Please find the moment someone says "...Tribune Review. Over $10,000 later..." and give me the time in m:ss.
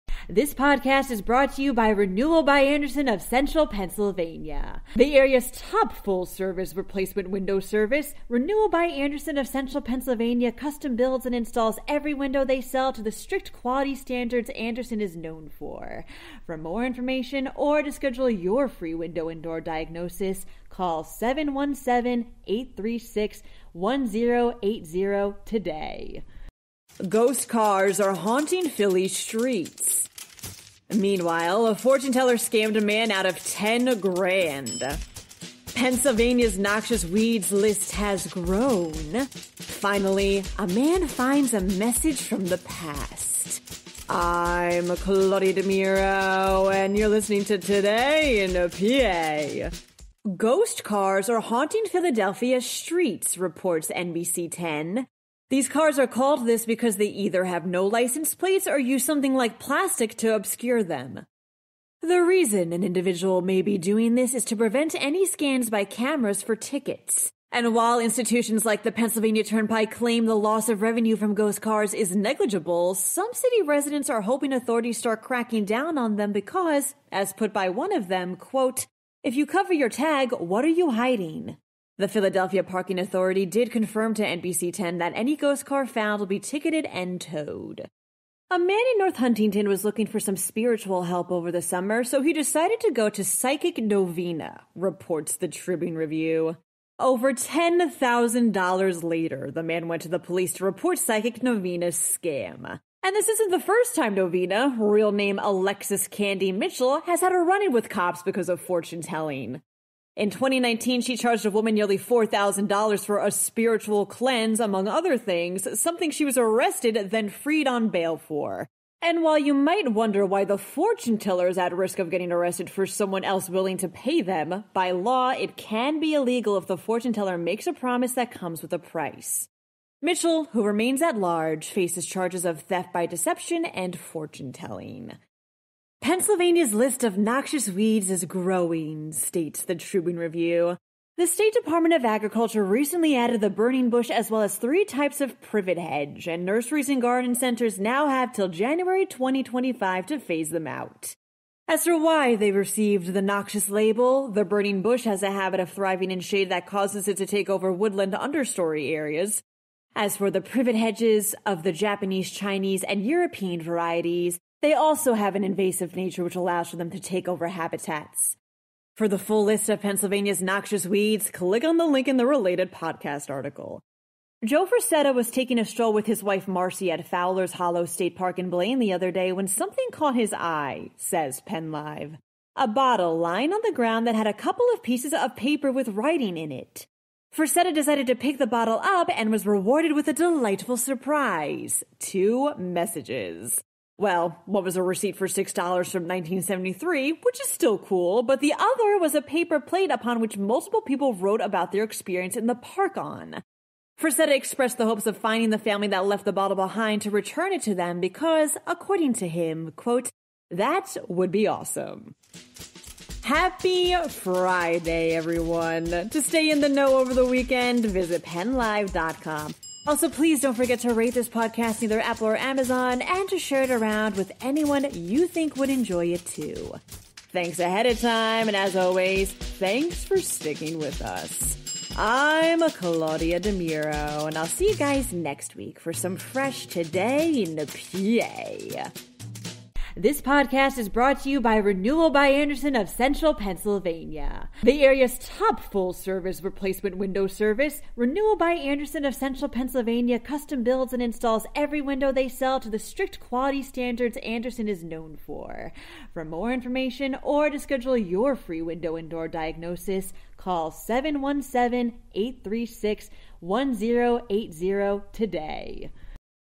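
1:35.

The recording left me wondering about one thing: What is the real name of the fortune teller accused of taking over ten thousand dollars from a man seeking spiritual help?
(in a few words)
Alexis Candy Mitchell.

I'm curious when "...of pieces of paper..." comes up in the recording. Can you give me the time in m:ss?
3:04.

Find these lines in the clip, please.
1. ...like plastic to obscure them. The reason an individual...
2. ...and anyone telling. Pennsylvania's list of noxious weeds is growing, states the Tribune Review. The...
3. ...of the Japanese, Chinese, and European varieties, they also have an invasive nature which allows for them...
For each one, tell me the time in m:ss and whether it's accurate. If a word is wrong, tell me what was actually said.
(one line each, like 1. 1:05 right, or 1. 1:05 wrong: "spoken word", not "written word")
1. 0:59 right
2. 2:13 wrong: "fortune", not "anyone"
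3. 2:41 right.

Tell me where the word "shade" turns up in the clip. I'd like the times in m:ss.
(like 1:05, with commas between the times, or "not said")
2:36.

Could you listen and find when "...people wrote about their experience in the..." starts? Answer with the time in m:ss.
3:20.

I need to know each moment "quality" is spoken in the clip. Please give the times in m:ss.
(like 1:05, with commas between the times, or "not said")
0:13, 4:13.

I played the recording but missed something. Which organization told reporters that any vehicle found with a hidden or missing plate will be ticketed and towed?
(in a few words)
Philadelphia Parking Authority.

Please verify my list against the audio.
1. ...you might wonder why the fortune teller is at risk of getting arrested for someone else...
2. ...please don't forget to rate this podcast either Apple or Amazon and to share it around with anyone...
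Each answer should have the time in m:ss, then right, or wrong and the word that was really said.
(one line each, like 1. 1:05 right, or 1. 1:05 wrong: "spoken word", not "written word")
1. 1:59 right
2. 3:40 right.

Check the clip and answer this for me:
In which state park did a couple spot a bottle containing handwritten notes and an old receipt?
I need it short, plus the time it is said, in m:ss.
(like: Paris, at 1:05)
Fowler's Hollow State Park, at 2:57.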